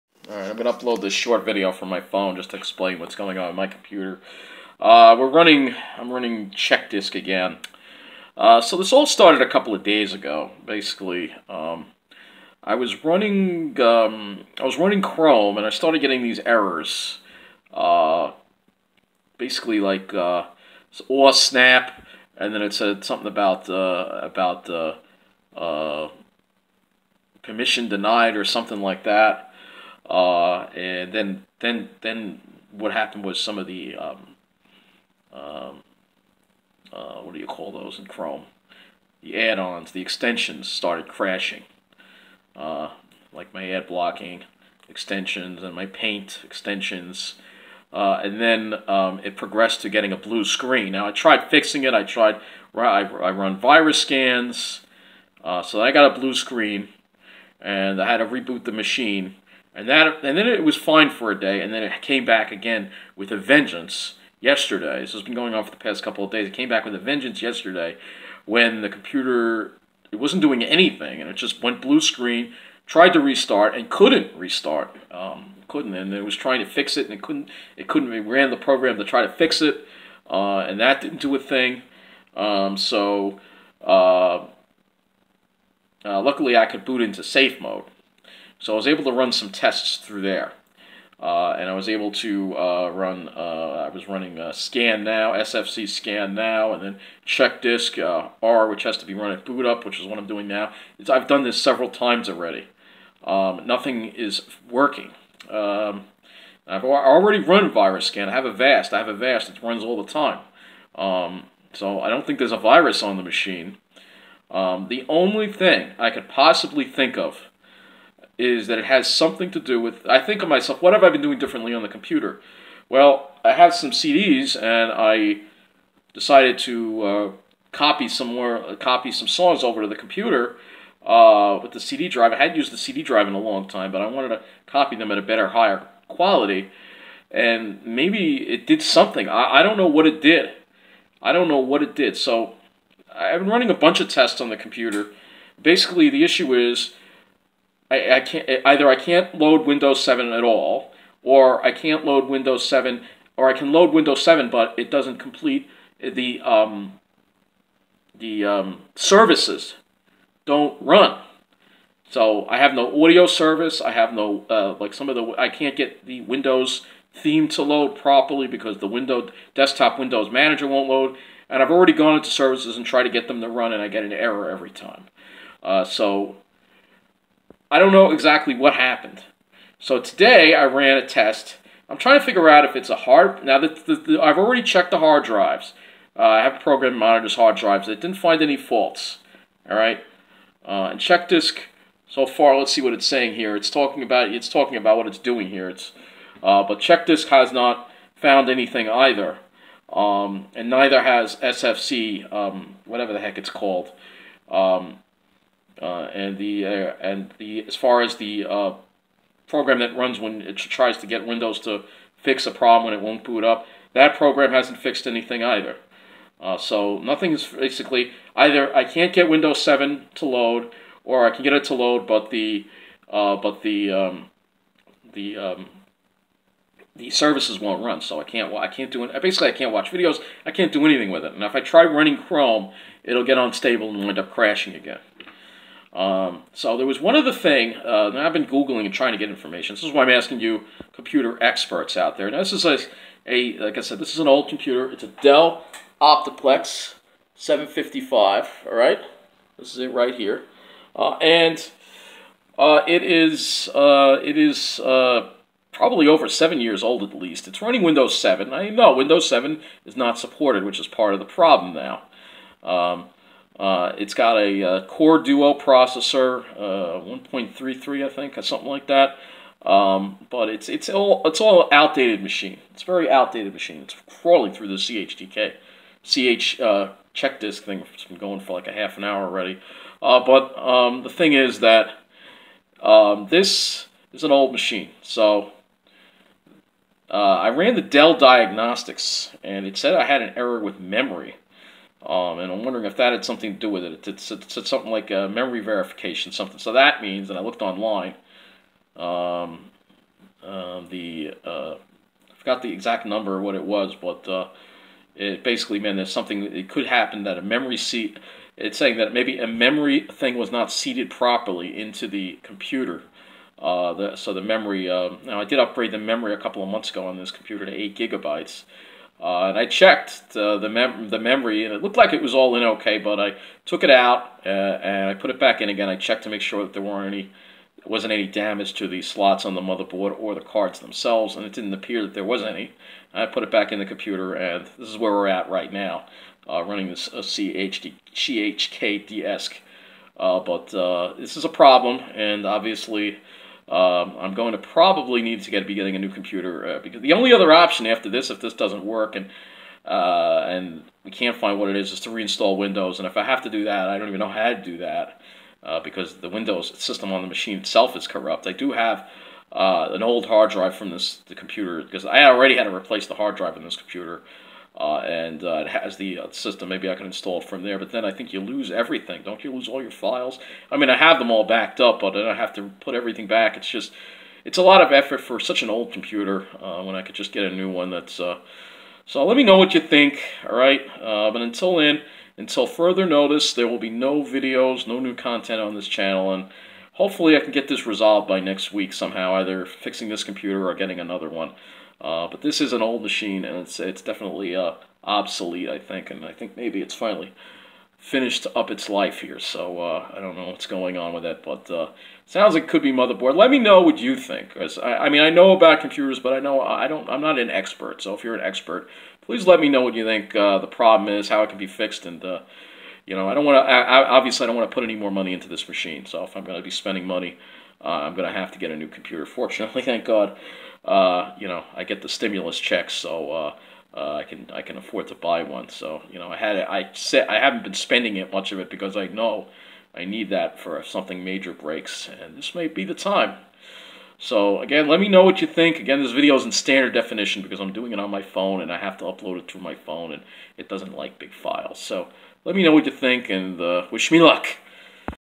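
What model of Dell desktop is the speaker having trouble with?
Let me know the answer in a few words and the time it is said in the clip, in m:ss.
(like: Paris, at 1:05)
Optiplex 755, at 4:05.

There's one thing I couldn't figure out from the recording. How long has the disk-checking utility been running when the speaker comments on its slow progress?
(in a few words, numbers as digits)
half an hour.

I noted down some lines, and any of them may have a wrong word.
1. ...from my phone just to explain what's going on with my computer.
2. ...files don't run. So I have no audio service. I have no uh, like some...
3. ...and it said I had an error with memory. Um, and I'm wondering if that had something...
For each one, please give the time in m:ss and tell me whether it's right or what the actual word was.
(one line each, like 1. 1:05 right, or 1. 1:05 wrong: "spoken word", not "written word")
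1. 0:01 right
2. 2:38 wrong: "services", not "files"
3. 4:49 right.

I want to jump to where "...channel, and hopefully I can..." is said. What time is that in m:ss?
6:25.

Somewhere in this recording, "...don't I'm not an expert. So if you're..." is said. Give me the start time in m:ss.
6:46.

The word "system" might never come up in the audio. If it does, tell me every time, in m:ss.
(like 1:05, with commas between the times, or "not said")
5:56, 6:06.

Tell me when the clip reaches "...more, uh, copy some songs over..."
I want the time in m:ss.
2:08.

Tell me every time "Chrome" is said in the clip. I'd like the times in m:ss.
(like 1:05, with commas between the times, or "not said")
0:15, 0:38, 3:52.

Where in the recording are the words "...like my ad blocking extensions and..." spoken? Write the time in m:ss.
0:43.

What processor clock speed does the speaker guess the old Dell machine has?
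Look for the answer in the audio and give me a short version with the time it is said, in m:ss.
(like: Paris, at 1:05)
1.33, at 4:27.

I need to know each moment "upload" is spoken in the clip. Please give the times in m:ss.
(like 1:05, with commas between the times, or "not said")
0:00, 7:19.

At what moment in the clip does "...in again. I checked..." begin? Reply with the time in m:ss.
5:25.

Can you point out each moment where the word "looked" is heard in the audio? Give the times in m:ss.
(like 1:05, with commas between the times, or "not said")
4:57, 5:21.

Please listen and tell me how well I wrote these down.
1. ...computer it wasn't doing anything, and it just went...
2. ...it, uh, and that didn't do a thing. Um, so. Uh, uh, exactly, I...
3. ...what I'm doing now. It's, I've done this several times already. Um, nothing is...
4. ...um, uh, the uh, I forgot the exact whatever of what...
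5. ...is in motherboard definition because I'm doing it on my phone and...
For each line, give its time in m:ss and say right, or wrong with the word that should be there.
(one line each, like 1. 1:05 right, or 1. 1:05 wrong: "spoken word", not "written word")
1. 1:08 right
2. 1:19 wrong: "luckily", not "exactly"
3. 1:40 right
4. 4:58 wrong: "number", not "whatever"
5. 7:16 wrong: "standard", not "motherboard".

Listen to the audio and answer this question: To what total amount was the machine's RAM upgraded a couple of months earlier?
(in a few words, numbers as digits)
8 gigabytes.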